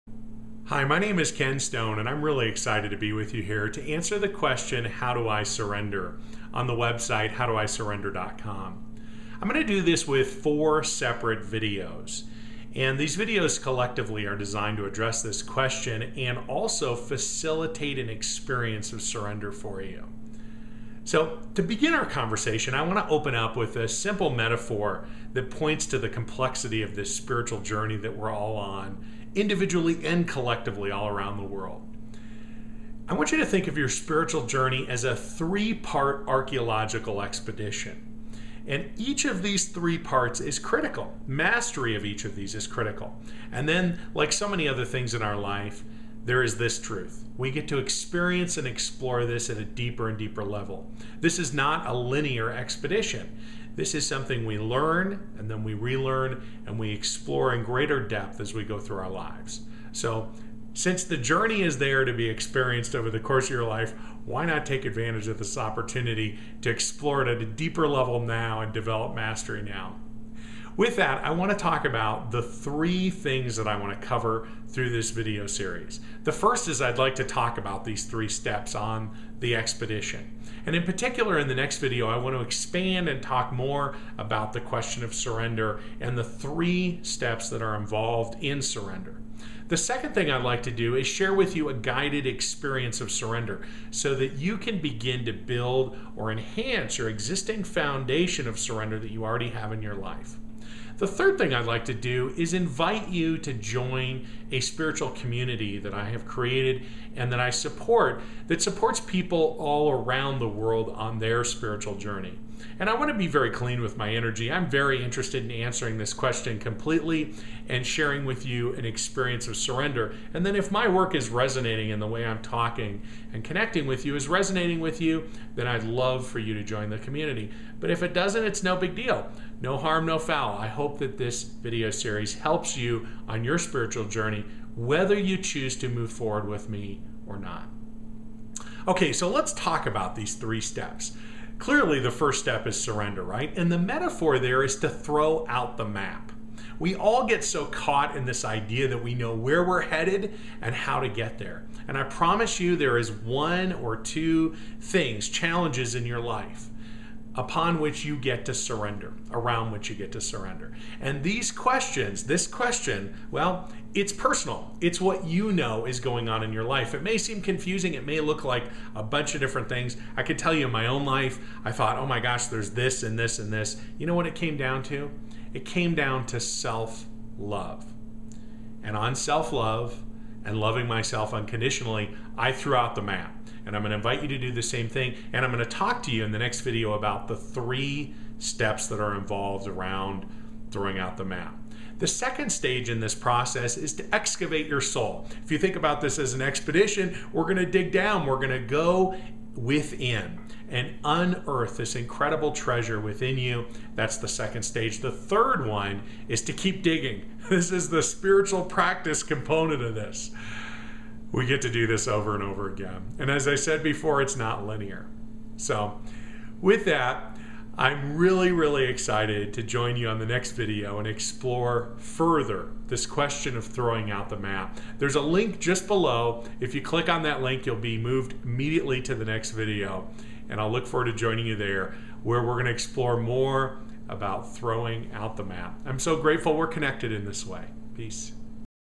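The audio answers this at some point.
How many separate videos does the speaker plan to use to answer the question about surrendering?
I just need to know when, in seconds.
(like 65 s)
10 s.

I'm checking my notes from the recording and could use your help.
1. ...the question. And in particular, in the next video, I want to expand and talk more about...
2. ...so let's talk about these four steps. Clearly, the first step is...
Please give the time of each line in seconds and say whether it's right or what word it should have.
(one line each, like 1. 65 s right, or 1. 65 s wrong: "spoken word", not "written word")
1. 79 s wrong: "expedition", not "question"
2. 139 s wrong: "three", not "four".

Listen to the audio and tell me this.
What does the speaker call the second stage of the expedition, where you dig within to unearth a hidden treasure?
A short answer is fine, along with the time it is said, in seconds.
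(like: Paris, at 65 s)
Excavate your soul, at 194 s.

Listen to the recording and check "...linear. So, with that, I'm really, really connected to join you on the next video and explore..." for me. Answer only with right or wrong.
wrong.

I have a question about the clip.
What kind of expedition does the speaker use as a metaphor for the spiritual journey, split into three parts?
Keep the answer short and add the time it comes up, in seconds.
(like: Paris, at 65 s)
Archaeological expedition, at 36 s.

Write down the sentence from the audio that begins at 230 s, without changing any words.
And I'll look forward to joining you there where we're going to explore more about throwing out the map.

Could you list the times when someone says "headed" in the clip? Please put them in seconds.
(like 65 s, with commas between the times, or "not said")
149 s.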